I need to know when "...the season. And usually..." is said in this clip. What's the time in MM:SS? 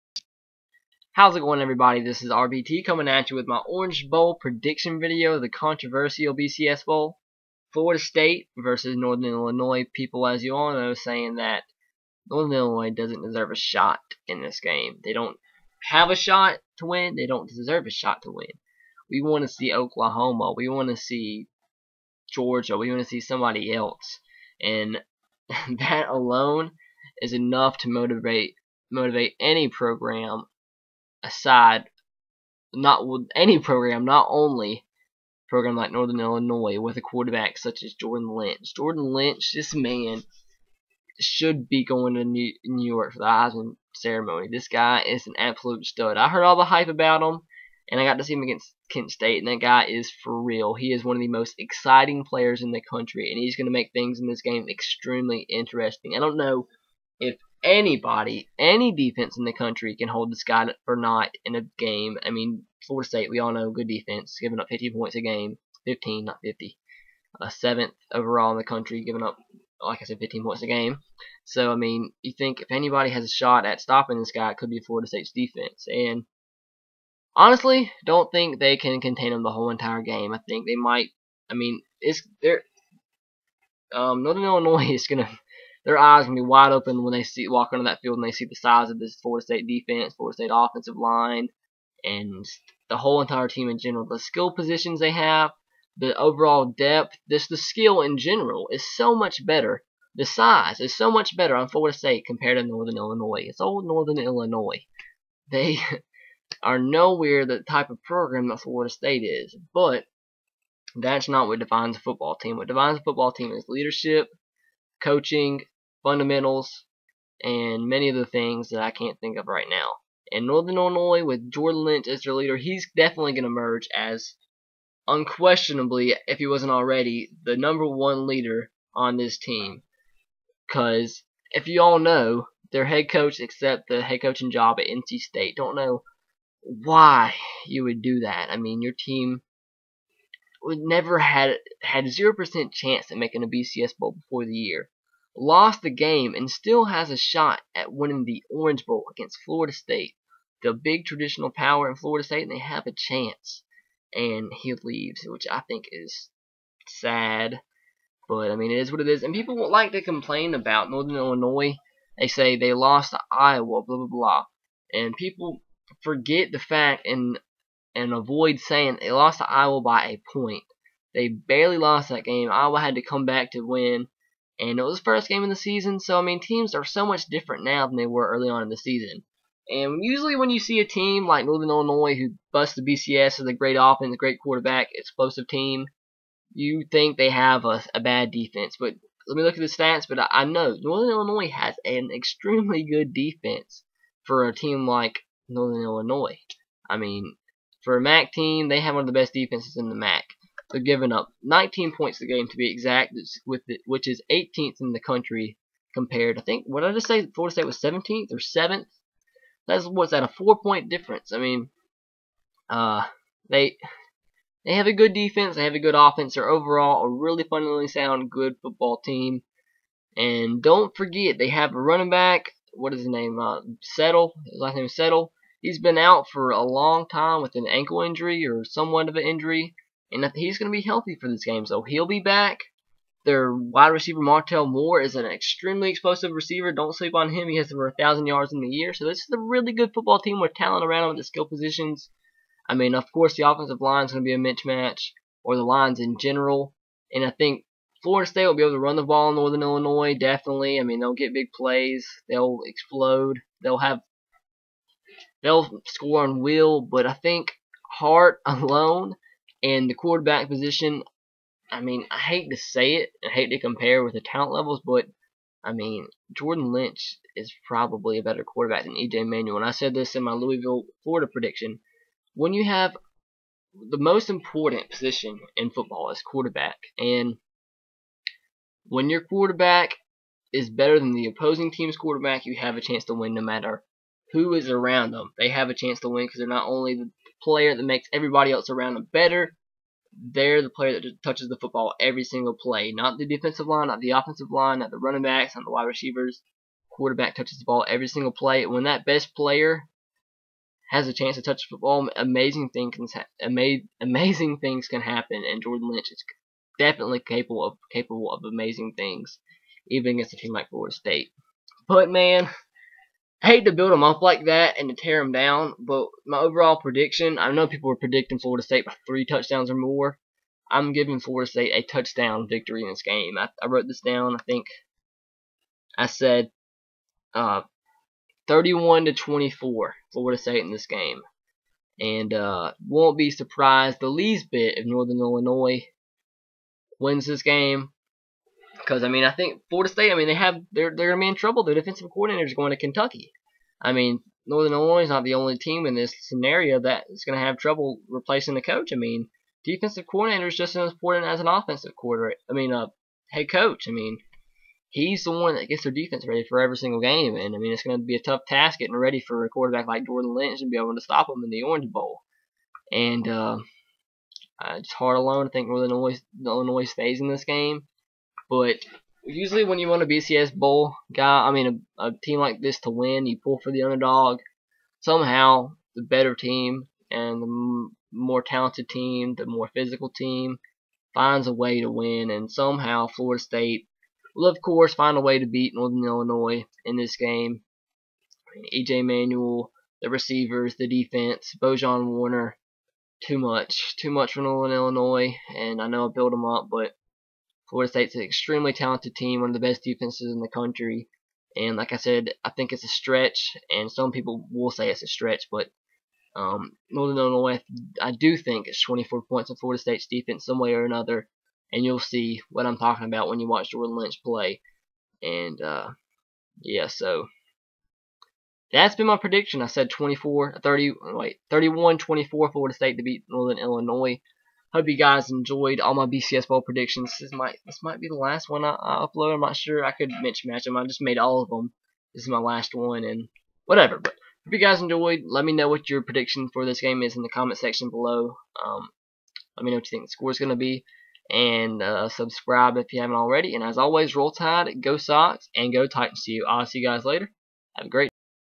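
02:58.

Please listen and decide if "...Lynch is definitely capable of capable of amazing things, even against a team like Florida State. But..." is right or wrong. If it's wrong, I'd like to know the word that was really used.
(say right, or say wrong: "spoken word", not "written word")
right.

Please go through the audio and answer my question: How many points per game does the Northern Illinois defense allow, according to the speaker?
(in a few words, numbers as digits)
19.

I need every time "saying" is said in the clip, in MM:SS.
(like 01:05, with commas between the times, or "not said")
00:10, 02:48.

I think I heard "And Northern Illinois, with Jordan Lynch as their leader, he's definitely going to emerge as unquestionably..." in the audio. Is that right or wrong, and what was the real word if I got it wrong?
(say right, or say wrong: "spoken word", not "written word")
right.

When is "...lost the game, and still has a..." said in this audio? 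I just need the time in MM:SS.
02:25.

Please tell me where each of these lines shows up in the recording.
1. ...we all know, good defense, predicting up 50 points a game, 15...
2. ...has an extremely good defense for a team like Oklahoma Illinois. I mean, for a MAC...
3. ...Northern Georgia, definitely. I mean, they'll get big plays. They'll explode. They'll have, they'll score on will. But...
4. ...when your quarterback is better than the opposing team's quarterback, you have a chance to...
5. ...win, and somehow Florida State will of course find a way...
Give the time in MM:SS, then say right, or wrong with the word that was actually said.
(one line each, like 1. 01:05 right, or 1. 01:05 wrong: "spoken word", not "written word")
1. 01:03 wrong: "giving", not "predicting"
2. 03:11 wrong: "Northern", not "Oklahoma"
3. 04:09 wrong: "Illinois", not "Georgia"
4. 04:38 right
5. 06:21 right.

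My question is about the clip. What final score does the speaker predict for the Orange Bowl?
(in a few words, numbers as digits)
31 to 24 Florida State.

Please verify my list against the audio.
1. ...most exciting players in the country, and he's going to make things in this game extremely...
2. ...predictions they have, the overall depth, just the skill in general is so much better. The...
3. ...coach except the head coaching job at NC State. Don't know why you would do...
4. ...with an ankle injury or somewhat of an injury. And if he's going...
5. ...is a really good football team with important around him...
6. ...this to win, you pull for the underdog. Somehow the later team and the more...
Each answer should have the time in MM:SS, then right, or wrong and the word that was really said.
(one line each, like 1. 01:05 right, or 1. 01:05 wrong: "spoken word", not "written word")
1. 00:51 right
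2. 01:34 wrong: "positions", not "predictions"
3. 02:13 right
4. 03:47 right
5. 03:59 wrong: "talent", not "important"
6. 06:12 wrong: "better", not "later".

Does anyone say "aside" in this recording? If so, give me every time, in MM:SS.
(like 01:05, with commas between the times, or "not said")
00:31.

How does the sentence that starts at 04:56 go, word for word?
Quarterback touches the ball every single play.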